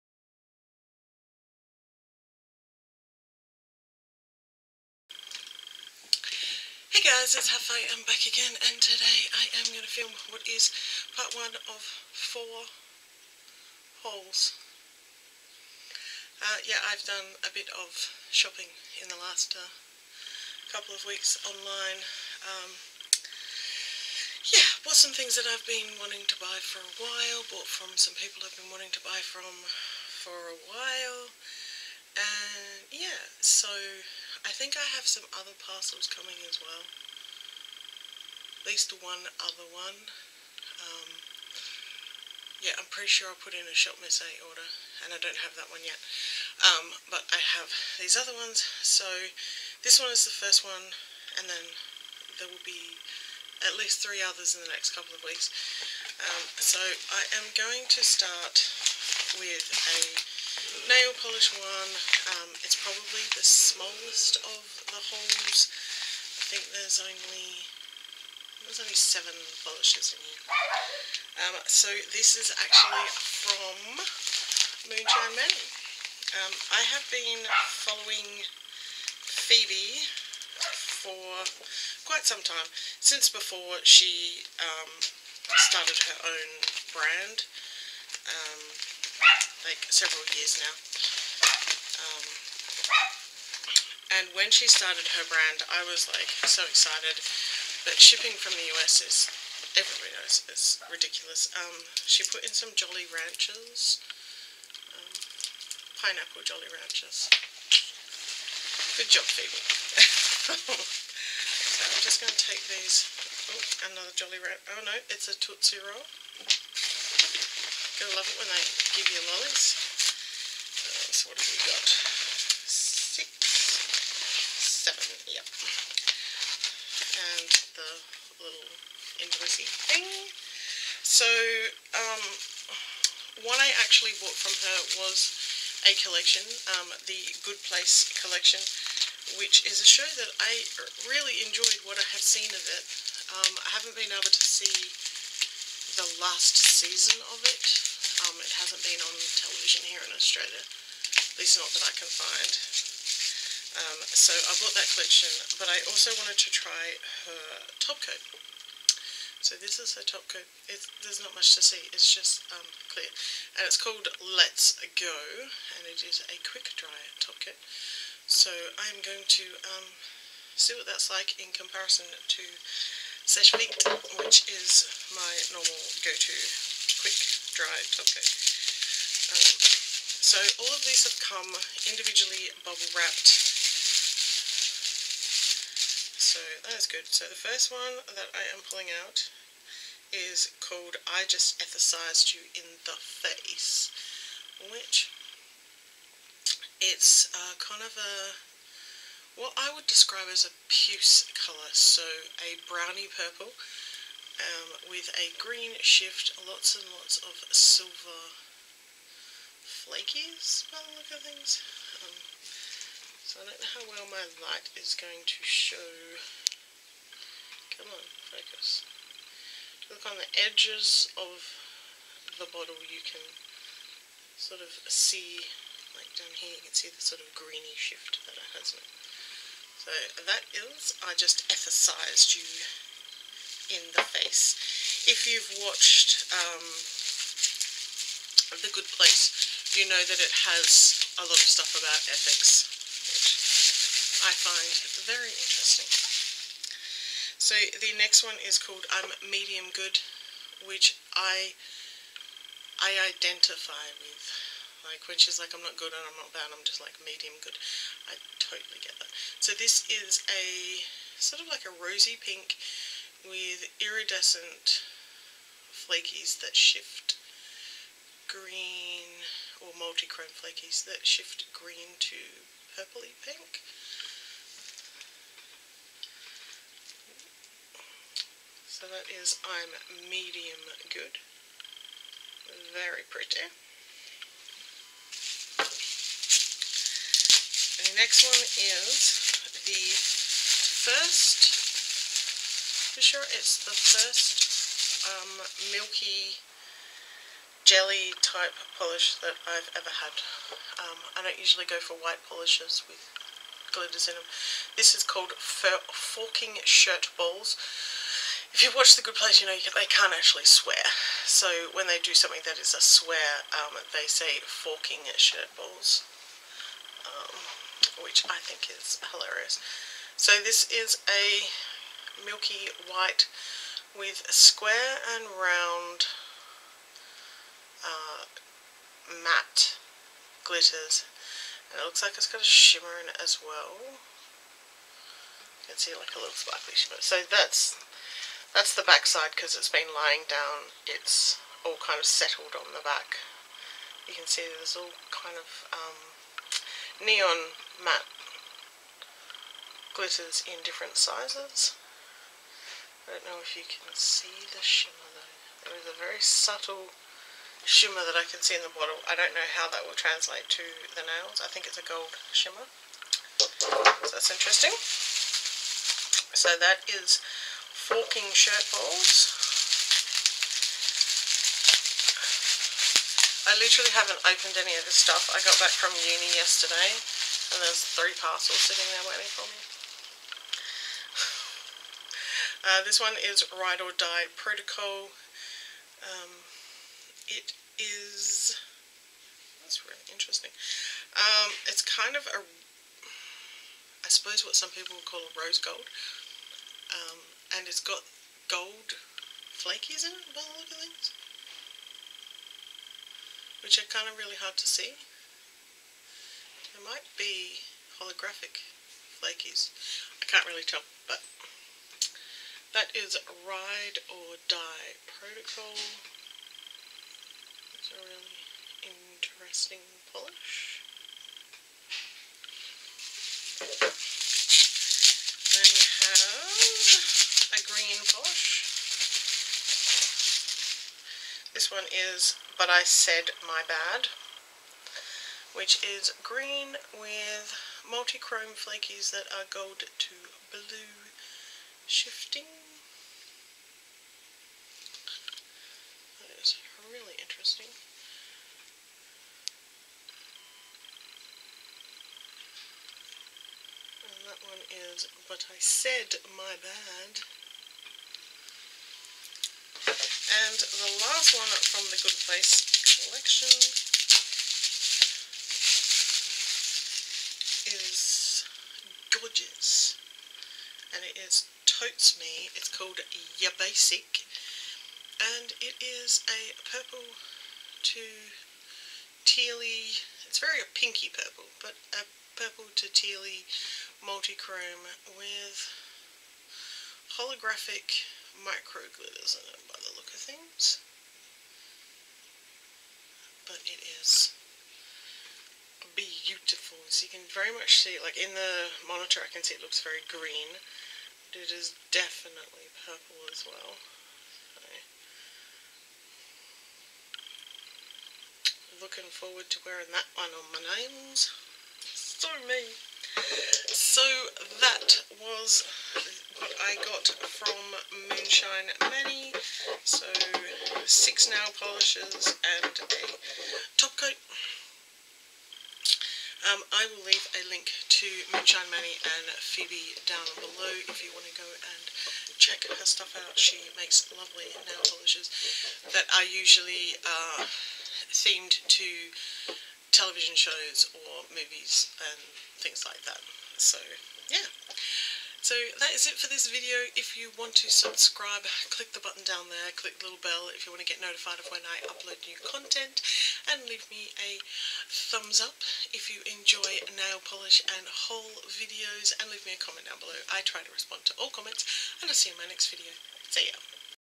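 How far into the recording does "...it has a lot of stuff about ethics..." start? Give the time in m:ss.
4:00.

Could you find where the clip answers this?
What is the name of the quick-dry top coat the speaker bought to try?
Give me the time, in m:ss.
2:44.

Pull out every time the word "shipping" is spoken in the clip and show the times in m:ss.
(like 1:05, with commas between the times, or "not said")
1:37.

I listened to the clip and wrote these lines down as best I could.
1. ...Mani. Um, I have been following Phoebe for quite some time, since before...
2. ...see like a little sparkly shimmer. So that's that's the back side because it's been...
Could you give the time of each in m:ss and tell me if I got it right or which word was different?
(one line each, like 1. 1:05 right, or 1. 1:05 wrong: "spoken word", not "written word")
1. 1:15 right
2. 5:35 right.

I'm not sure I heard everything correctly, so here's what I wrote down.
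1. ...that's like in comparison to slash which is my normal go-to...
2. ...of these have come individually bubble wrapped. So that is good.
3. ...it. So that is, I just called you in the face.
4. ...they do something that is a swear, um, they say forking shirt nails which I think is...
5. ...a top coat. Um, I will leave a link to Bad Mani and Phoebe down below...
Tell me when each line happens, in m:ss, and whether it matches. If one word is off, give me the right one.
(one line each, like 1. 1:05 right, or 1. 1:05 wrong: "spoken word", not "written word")
1. 2:50 right
2. 3:00 right
3. 3:48 wrong: "emphasized", not "called"
4. 5:11 wrong: "balls", not "nails"
5. 8:42 wrong: "Moonshine", not "Bad".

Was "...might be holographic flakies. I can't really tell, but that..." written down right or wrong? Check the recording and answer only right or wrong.
right.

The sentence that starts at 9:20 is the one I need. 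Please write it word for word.
I try to respond to all comments, and I'll see you in my next video.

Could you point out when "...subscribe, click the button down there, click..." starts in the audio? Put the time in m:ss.
9:07.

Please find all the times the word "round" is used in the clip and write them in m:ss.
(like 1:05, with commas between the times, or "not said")
5:25.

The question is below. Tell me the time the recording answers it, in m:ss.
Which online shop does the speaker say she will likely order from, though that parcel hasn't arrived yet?
0:43.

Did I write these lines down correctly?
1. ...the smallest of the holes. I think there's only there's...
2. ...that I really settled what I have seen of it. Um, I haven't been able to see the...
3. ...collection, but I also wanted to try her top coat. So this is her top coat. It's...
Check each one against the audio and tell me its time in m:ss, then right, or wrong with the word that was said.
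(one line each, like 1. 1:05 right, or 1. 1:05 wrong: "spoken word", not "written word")
1. 1:03 right
2. 2:20 wrong: "enjoyed", not "settled"
3. 2:34 right.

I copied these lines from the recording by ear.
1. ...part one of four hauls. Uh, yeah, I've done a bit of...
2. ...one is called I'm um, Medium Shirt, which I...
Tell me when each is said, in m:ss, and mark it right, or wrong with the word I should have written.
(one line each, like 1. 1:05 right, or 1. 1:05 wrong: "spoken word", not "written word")
1. 0:11 right
2. 4:08 wrong: "Good", not "Shirt".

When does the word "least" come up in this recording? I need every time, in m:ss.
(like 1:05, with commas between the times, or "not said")
0:38, 0:53, 2:31.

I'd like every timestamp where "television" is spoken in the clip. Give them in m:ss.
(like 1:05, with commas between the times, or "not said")
2:29, 8:59.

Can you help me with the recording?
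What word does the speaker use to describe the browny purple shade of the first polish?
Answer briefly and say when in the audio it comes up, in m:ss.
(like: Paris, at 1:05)
Puce, at 3:20.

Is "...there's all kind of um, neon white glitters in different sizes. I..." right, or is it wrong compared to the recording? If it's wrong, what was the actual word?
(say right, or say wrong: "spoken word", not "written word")
wrong: "matte", not "white".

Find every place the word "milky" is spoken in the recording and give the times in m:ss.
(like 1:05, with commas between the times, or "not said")
4:55, 5:22.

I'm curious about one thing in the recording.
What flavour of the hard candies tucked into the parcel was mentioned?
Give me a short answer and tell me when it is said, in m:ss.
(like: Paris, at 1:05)
Pineapple, at 1:46.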